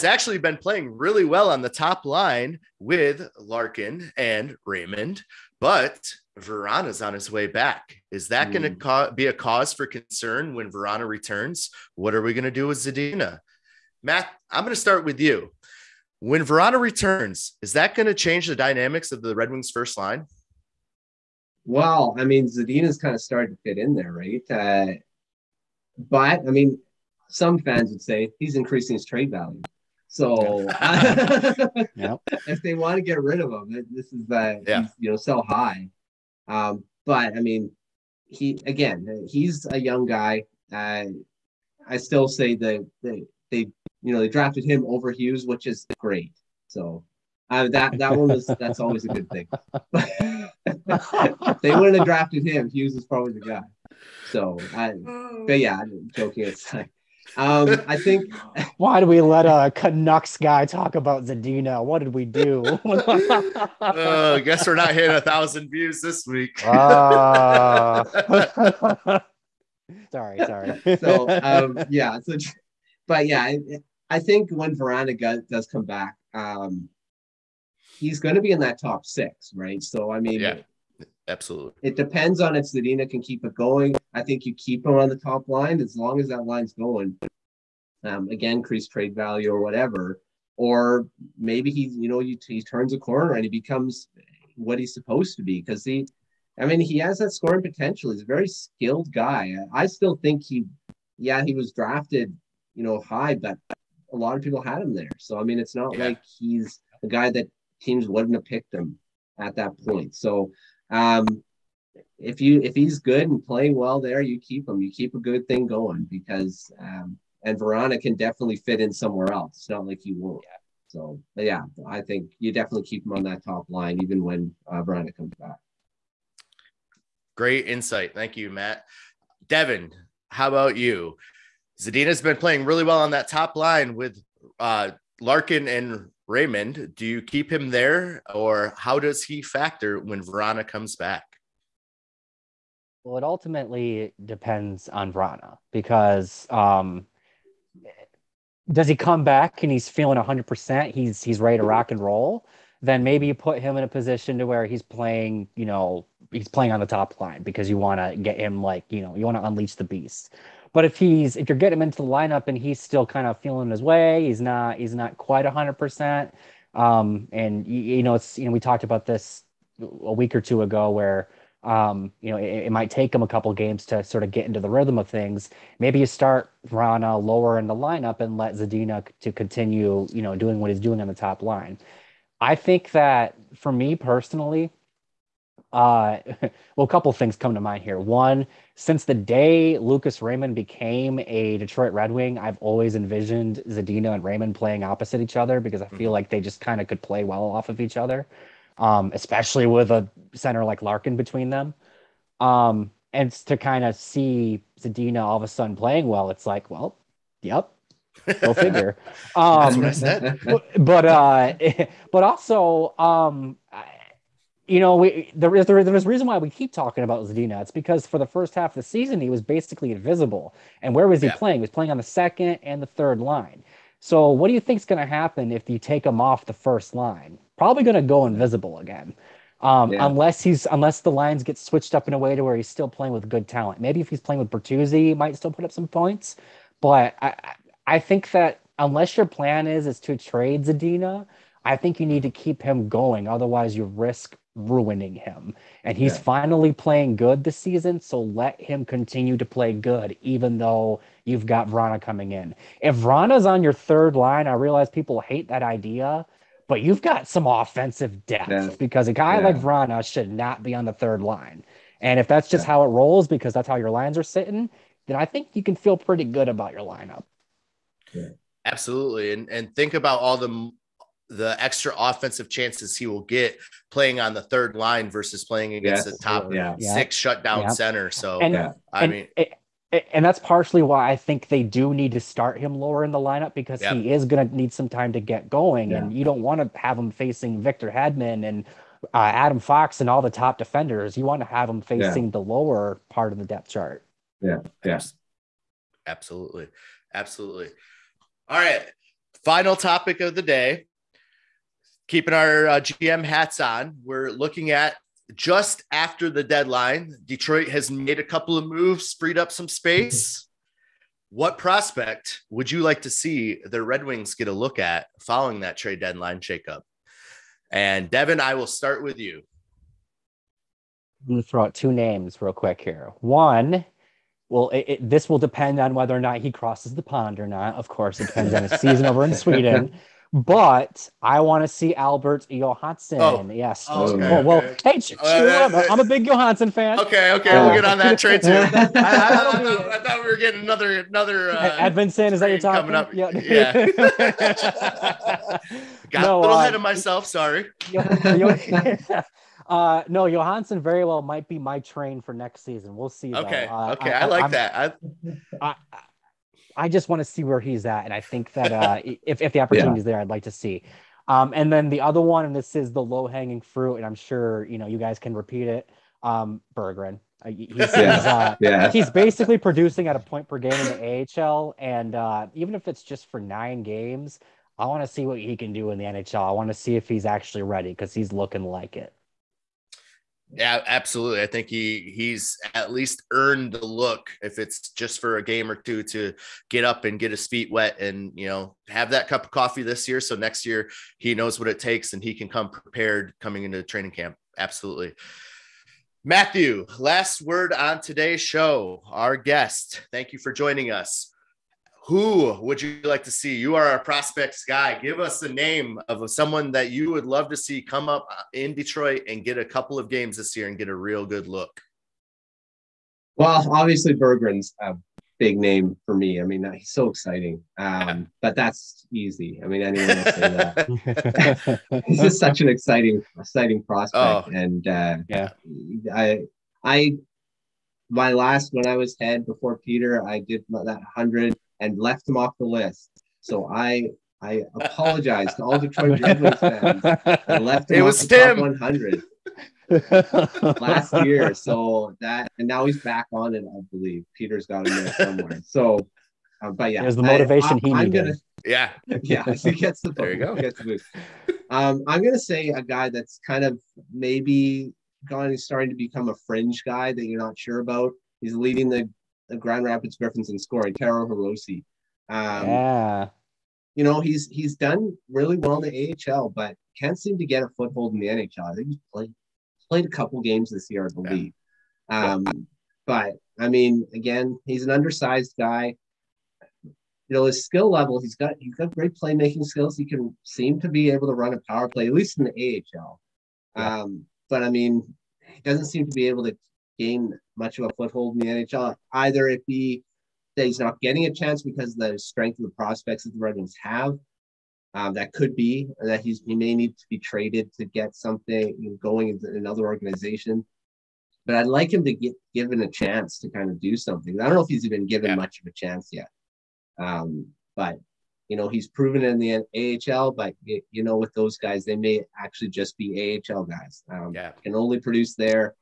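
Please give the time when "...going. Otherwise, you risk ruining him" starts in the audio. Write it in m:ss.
4:02.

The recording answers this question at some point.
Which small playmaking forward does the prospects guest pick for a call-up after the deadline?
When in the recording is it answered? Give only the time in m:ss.
7:40.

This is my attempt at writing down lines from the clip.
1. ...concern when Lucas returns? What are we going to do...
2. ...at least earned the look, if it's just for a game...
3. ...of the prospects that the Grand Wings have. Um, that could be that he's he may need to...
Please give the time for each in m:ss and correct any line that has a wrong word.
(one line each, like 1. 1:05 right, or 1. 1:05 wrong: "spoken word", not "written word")
1. 0:09 wrong: "Vrana", not "Lucas"
2. 6:22 right
3. 8:12 wrong: "Red", not "Grand".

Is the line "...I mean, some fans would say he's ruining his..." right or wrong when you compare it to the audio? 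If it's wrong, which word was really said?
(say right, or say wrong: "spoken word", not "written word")
wrong: "increasing", not "ruining".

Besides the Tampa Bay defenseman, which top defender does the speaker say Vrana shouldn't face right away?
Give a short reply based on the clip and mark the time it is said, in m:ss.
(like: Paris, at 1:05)
Adam Fox, at 4:49.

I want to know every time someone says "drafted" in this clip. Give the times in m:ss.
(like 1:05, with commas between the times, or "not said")
0:44, 0:52, 1:41.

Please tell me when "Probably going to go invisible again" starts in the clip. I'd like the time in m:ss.
3:47.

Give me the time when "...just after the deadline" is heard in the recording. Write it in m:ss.
5:05.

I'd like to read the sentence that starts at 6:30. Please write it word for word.
So next year he knows what it takes and he can come prepared coming into training camp.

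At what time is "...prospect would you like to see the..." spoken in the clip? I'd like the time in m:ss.
5:11.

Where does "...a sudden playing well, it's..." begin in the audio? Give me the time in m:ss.
3:25.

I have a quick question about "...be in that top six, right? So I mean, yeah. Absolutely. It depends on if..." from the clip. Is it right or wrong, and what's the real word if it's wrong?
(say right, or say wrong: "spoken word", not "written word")
right.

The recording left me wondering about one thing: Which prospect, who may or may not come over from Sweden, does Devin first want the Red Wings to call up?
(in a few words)
Albert Johansson.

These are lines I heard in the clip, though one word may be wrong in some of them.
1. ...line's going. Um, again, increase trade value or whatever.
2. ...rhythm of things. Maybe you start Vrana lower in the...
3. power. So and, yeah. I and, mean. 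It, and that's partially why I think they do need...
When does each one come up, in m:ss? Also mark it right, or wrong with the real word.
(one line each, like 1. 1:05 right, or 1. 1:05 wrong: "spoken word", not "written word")
1. 1:26 right
2. 2:54 right
3. 4:37 wrong: "center", not "power".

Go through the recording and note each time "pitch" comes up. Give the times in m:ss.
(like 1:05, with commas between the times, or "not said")
not said.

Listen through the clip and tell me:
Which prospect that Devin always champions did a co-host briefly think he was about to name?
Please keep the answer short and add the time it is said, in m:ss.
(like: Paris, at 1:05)
Edvinsson, at 5:41.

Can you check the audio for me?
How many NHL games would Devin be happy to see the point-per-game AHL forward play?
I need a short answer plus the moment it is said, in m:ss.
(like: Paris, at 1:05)
9, at 6:13.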